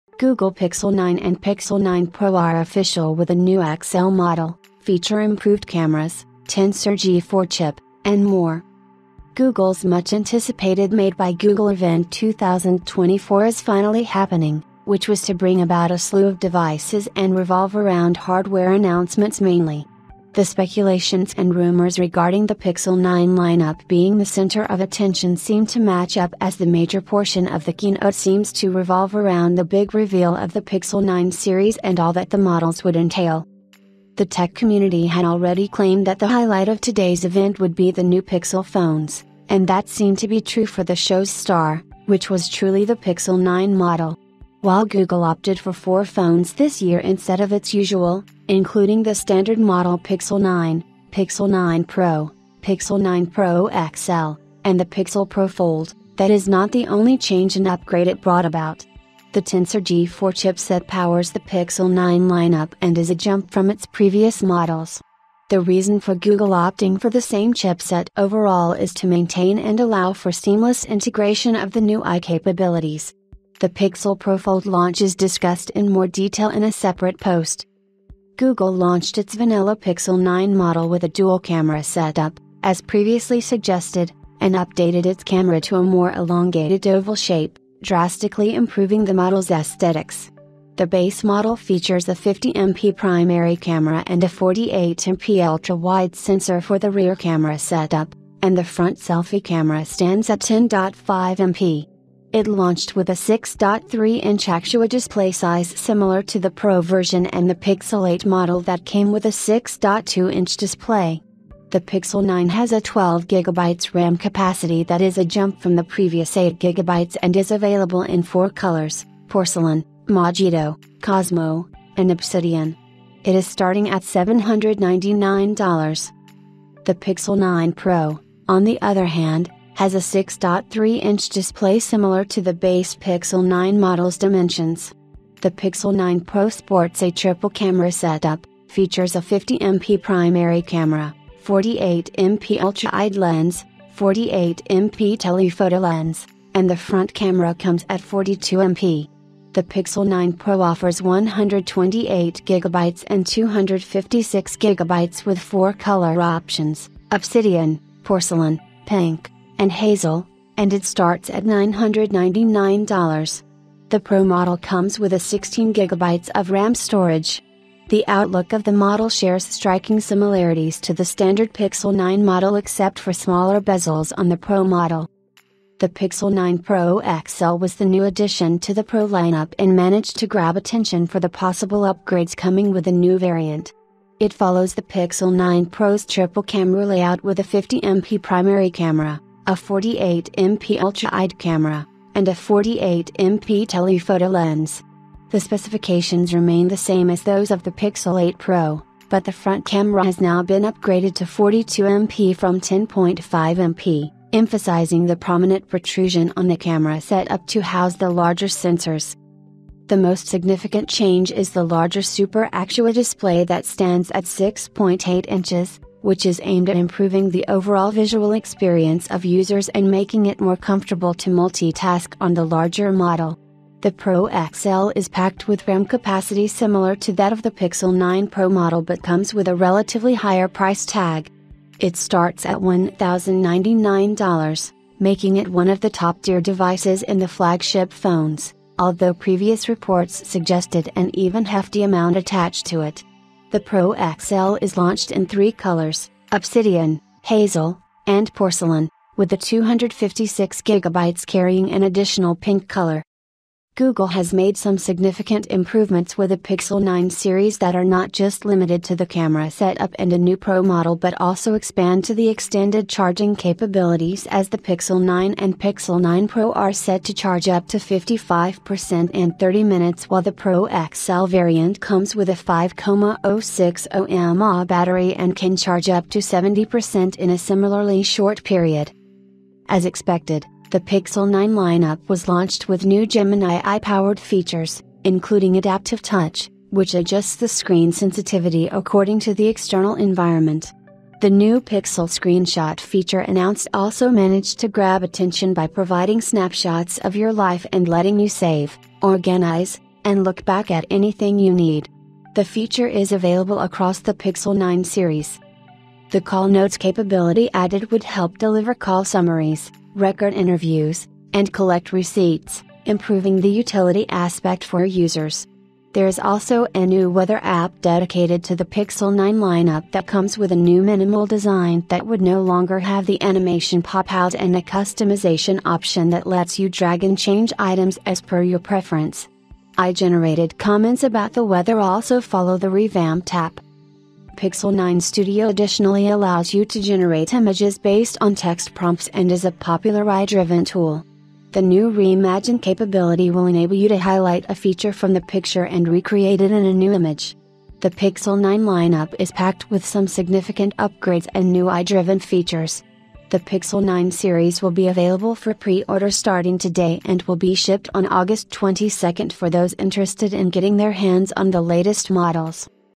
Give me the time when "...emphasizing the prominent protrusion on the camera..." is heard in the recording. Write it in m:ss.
3:24.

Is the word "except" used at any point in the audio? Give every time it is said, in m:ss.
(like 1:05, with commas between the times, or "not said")
2:52.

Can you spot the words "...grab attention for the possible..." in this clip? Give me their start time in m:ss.
3:00.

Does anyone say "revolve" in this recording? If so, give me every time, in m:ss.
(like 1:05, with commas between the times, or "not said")
0:17, 0:28.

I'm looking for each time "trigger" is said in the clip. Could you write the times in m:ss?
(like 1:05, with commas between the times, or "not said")
not said.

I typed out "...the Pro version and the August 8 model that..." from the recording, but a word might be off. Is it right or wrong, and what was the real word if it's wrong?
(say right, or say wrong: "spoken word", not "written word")
wrong: "Pixel", not "August".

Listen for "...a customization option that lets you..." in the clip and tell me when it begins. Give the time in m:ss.
5:24.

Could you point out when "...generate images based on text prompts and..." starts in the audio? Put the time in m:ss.
5:36.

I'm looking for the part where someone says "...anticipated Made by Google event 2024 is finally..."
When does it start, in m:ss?
0:10.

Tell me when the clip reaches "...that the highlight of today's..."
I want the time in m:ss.
0:36.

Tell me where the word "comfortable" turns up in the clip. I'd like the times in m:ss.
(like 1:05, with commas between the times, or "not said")
3:40.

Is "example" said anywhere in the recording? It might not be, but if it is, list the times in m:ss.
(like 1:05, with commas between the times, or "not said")
not said.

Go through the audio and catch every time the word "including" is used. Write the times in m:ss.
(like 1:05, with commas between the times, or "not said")
0:48, 4:45.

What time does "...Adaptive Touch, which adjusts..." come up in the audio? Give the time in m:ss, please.
4:45.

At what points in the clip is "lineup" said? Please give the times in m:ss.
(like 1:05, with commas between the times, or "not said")
0:23, 1:02, 2:59, 4:41, 5:19, 5:48.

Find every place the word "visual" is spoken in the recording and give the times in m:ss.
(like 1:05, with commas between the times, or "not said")
3:37.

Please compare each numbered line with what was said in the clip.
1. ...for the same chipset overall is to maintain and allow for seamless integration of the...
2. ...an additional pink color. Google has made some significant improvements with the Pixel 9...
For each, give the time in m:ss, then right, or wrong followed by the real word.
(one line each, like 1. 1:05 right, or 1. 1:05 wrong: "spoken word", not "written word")
1. 1:07 right
2. 4:11 right.